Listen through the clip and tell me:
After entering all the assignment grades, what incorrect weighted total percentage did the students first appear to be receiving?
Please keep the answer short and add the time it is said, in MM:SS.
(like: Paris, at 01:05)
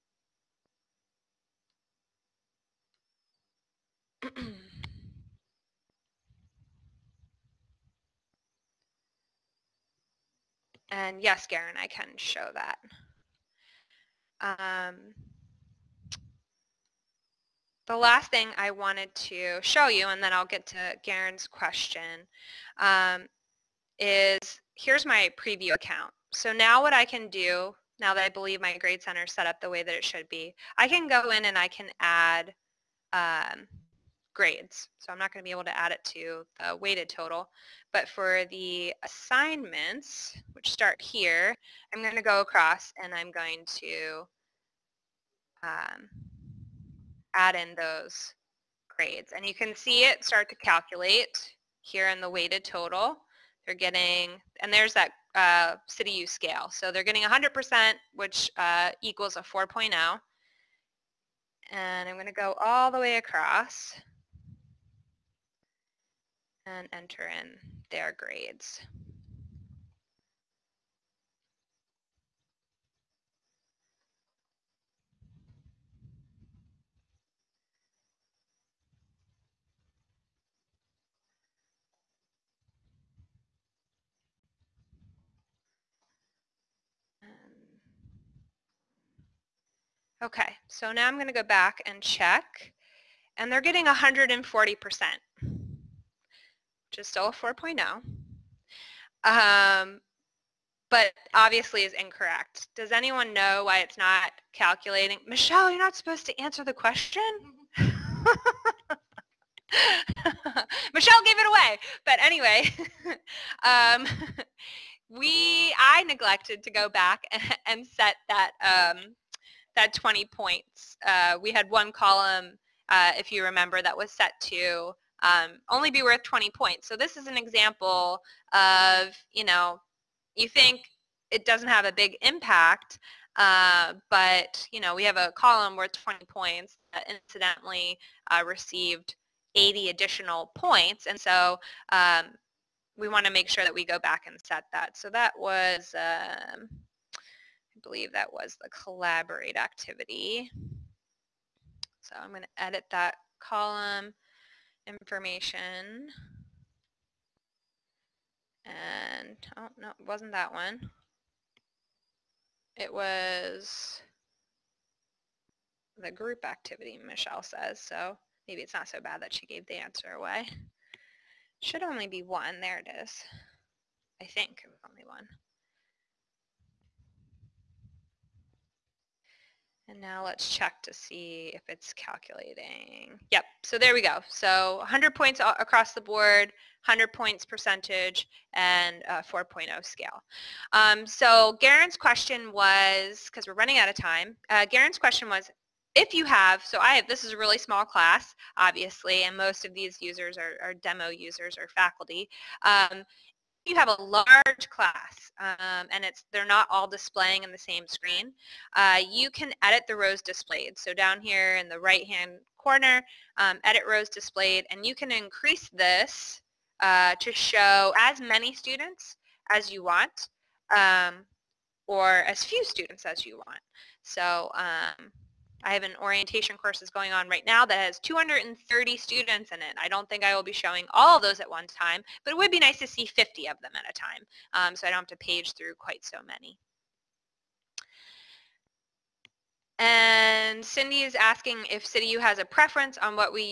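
140%, at 01:33.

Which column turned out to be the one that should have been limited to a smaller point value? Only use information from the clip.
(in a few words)
group activity.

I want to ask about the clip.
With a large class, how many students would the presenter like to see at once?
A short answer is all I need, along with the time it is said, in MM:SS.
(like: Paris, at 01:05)
50, at 03:53.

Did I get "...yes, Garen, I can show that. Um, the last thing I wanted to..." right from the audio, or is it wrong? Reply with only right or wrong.
right.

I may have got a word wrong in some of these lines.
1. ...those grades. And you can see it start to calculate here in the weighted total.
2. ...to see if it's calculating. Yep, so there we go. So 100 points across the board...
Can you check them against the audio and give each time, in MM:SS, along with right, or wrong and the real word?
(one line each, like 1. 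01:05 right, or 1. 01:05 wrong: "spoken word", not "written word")
1. 00:47 right
2. 03:00 right.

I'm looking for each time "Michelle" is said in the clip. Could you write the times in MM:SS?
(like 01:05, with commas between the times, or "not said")
01:45, 01:50, 02:47.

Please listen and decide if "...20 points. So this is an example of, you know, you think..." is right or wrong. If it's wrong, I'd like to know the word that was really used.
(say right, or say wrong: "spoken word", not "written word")
right.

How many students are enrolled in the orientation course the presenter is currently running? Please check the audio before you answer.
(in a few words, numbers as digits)
230.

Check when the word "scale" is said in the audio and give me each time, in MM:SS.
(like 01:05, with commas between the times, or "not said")
00:56, 03:09.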